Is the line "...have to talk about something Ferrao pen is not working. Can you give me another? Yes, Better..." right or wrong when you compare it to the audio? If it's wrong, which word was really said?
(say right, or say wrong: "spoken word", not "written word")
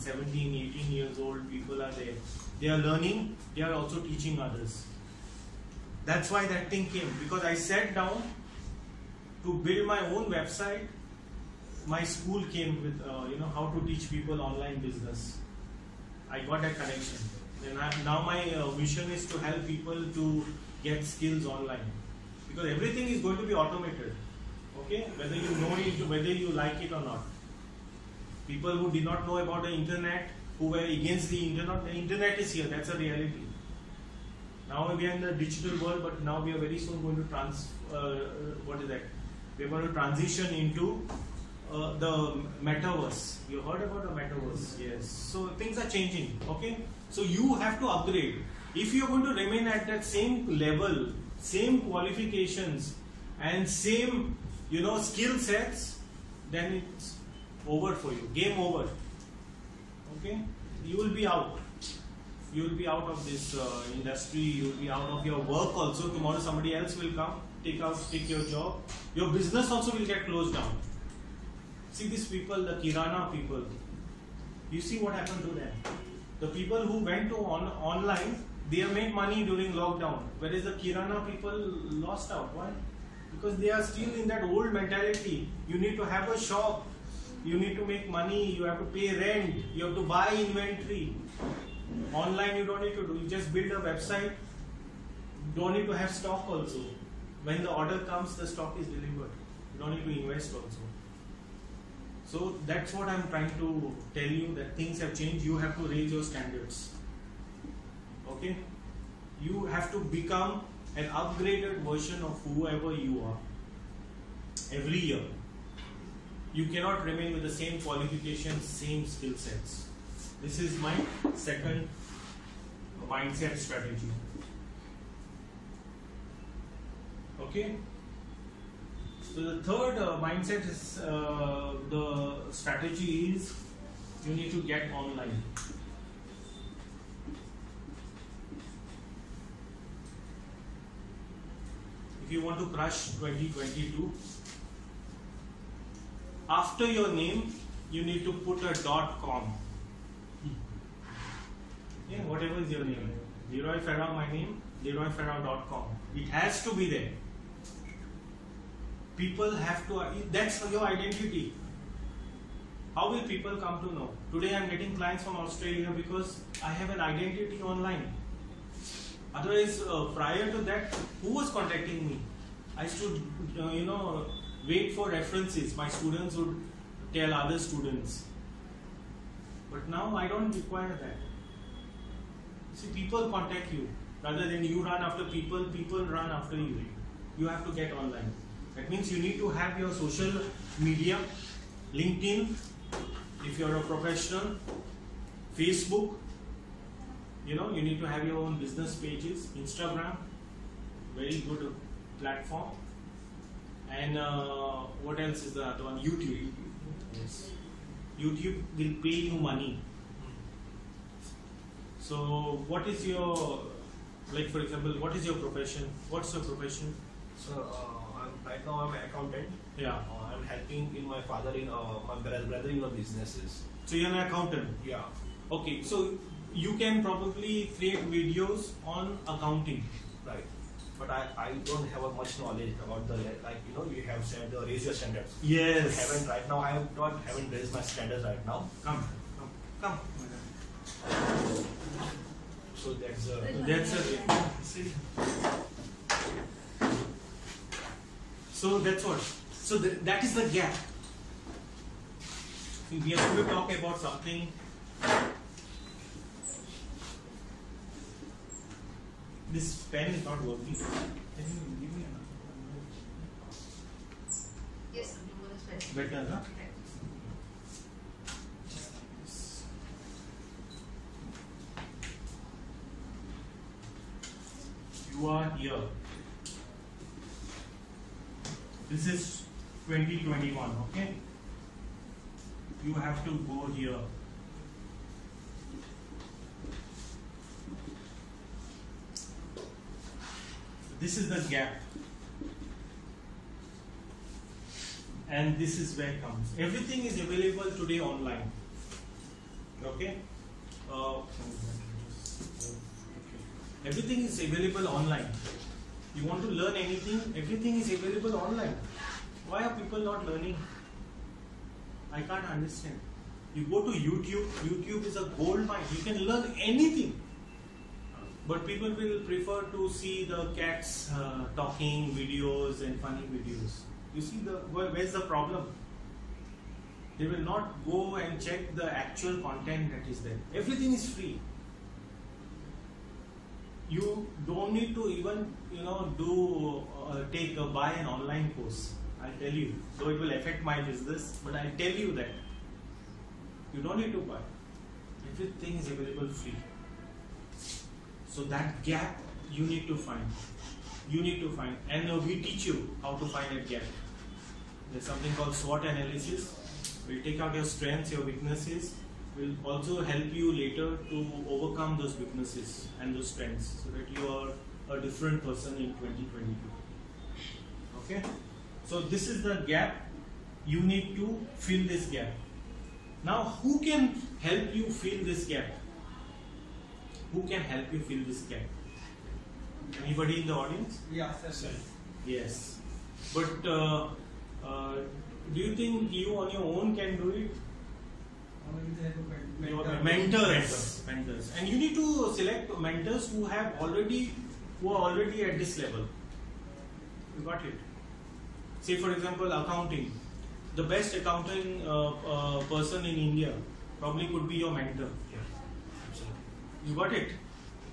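wrong: "This", not "Ferrao".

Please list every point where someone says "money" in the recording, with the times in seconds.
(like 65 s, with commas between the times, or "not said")
79 s, 88 s, 209 s.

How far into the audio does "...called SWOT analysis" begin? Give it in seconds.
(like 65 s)
355 s.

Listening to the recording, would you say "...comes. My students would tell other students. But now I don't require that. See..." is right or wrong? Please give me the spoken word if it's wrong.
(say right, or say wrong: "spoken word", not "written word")
wrong: "references", not "comes".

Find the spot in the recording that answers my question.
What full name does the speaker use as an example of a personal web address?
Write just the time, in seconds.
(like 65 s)
153 s.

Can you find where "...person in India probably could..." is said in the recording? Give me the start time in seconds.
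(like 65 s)
402 s.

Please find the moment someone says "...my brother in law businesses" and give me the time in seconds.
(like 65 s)
222 s.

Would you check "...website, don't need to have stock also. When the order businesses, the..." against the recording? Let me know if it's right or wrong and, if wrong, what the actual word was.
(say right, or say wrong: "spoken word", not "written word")
wrong: "comes", not "businesses".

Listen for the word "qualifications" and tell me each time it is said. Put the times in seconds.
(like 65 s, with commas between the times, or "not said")
51 s, 117 s.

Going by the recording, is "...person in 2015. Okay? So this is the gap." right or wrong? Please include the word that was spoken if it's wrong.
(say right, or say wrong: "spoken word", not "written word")
wrong: "2022", not "2015".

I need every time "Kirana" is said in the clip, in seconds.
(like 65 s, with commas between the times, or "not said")
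72 s, 80 s.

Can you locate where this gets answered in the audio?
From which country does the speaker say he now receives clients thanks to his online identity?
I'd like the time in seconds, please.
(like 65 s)
165 s.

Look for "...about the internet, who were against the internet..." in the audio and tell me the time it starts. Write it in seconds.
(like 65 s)
29 s.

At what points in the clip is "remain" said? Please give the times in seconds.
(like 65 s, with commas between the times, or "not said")
49 s, 117 s.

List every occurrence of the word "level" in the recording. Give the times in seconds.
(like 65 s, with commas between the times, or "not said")
50 s, 395 s.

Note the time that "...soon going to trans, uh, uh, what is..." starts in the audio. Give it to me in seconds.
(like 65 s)
36 s.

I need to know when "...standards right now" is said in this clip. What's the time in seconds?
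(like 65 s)
237 s.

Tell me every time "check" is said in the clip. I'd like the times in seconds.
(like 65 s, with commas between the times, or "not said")
328 s.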